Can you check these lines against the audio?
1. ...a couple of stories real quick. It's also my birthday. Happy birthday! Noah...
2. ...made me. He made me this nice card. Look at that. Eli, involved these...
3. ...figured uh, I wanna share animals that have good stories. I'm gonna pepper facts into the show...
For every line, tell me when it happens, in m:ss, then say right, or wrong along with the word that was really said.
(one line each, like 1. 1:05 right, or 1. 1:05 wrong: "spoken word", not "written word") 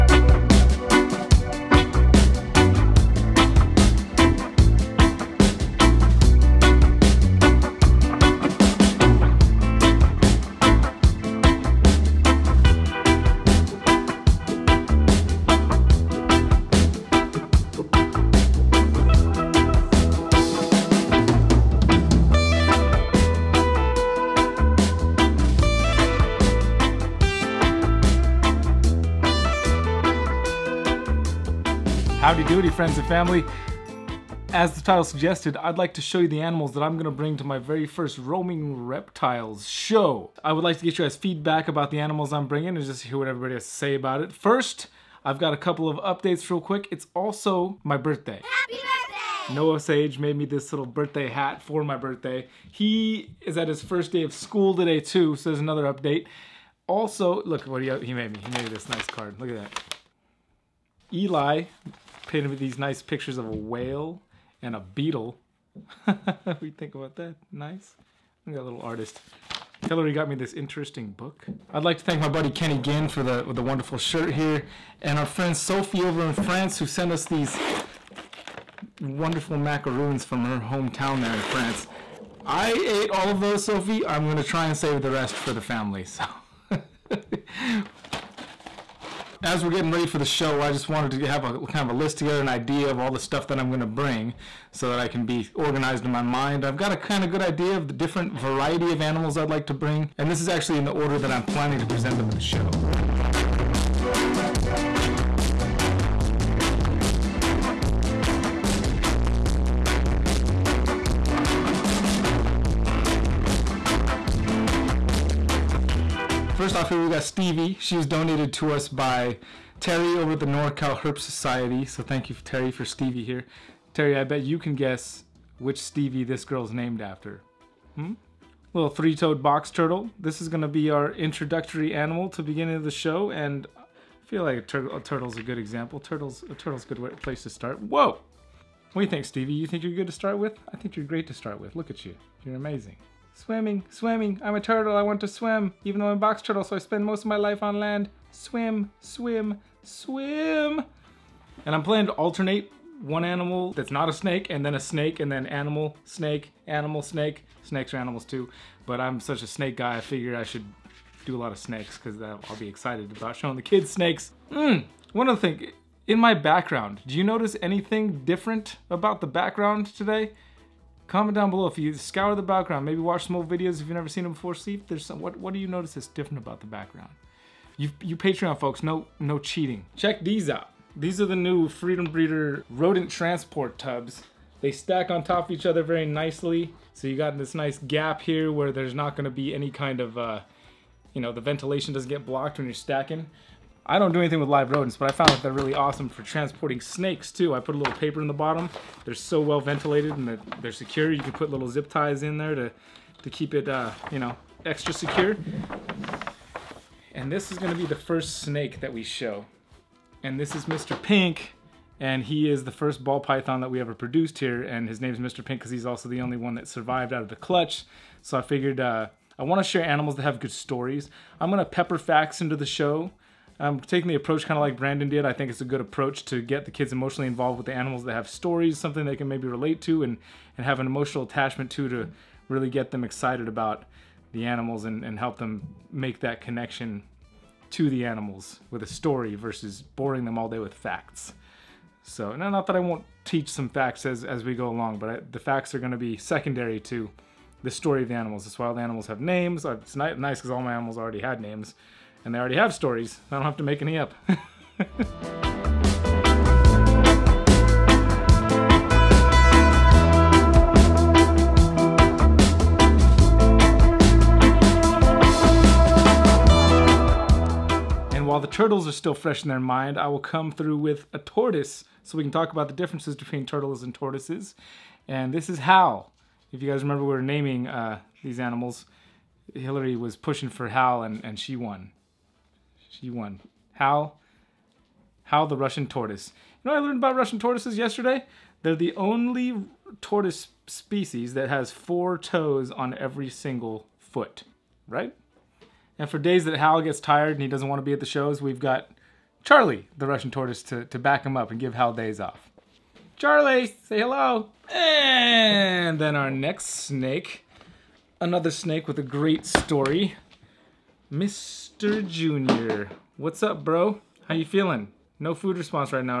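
1. 0:45 wrong: "updates", not "stories"
2. 0:58 wrong: "painted", not "involved"
3. 3:38 right.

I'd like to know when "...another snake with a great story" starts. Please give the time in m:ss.
5:08.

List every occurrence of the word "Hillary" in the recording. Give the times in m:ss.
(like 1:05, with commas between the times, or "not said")
1:09, 4:39.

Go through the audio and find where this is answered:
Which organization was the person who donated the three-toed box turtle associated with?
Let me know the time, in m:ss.
2:00.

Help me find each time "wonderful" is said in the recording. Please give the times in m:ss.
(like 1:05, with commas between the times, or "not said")
1:13, 1:19.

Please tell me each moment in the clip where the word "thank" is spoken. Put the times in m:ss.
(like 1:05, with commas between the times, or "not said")
1:12, 2:02.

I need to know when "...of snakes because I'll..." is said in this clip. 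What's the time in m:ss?
2:41.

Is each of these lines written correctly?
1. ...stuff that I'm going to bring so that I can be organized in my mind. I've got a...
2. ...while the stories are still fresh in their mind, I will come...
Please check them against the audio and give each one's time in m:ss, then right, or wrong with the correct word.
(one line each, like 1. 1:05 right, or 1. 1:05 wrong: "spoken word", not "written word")
1. 1:33 right
2. 4:28 wrong: "turtles", not "stories".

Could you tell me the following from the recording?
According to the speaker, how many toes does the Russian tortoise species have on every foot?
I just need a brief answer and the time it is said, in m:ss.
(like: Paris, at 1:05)
4, at 4:51.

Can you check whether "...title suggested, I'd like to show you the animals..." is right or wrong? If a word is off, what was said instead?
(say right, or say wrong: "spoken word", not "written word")
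right.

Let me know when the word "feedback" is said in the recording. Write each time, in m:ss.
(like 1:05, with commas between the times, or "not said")
0:41.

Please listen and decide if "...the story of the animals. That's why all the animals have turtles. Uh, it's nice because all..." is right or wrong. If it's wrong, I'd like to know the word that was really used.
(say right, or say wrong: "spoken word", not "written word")
wrong: "names", not "turtles".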